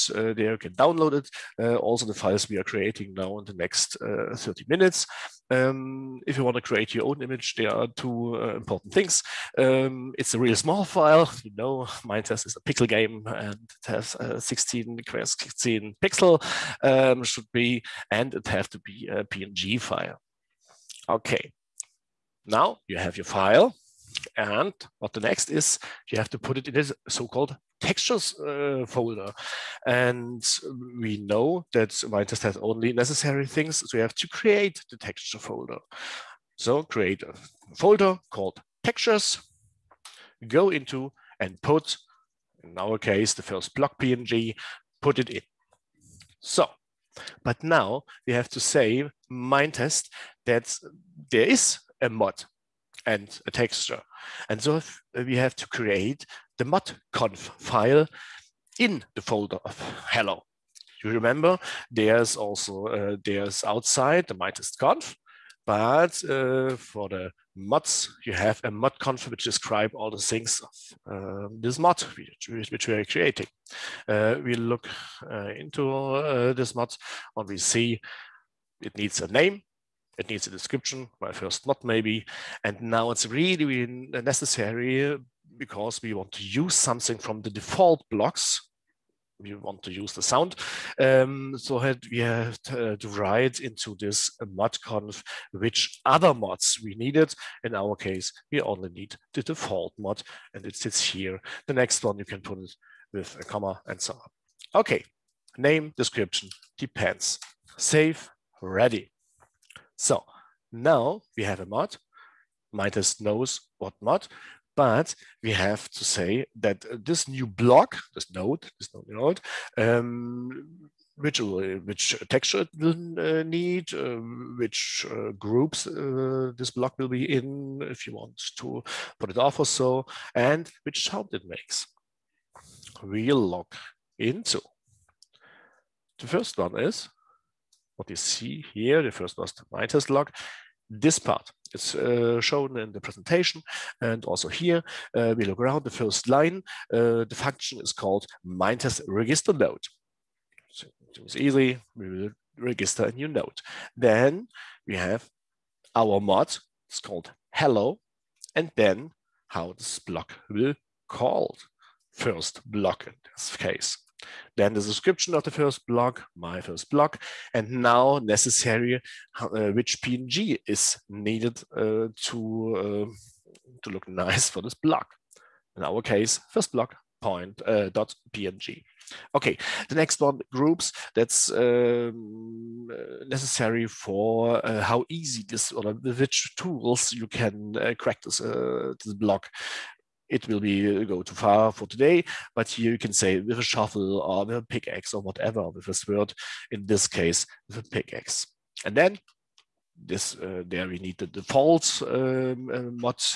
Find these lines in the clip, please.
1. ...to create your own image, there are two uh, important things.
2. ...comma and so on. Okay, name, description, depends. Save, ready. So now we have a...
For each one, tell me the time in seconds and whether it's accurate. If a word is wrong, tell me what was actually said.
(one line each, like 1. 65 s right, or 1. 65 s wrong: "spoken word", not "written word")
1. 6 s right
2. 103 s right.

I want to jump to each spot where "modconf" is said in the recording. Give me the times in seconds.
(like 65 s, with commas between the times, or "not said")
56 s, 94 s.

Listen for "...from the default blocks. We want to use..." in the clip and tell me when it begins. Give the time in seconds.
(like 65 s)
87 s.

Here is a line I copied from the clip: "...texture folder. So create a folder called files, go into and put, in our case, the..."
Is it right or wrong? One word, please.
wrong.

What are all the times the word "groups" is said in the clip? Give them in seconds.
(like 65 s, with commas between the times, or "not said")
125 s, 180 s.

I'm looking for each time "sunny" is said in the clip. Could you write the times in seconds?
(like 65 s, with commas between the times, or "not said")
not said.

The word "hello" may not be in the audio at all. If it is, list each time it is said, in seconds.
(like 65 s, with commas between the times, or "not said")
60 s, 157 s.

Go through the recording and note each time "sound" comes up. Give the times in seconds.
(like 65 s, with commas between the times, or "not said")
90 s, 131 s.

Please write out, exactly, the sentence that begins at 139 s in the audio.
The first was the Minetest log this part.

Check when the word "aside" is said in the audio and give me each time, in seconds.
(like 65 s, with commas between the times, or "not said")
not said.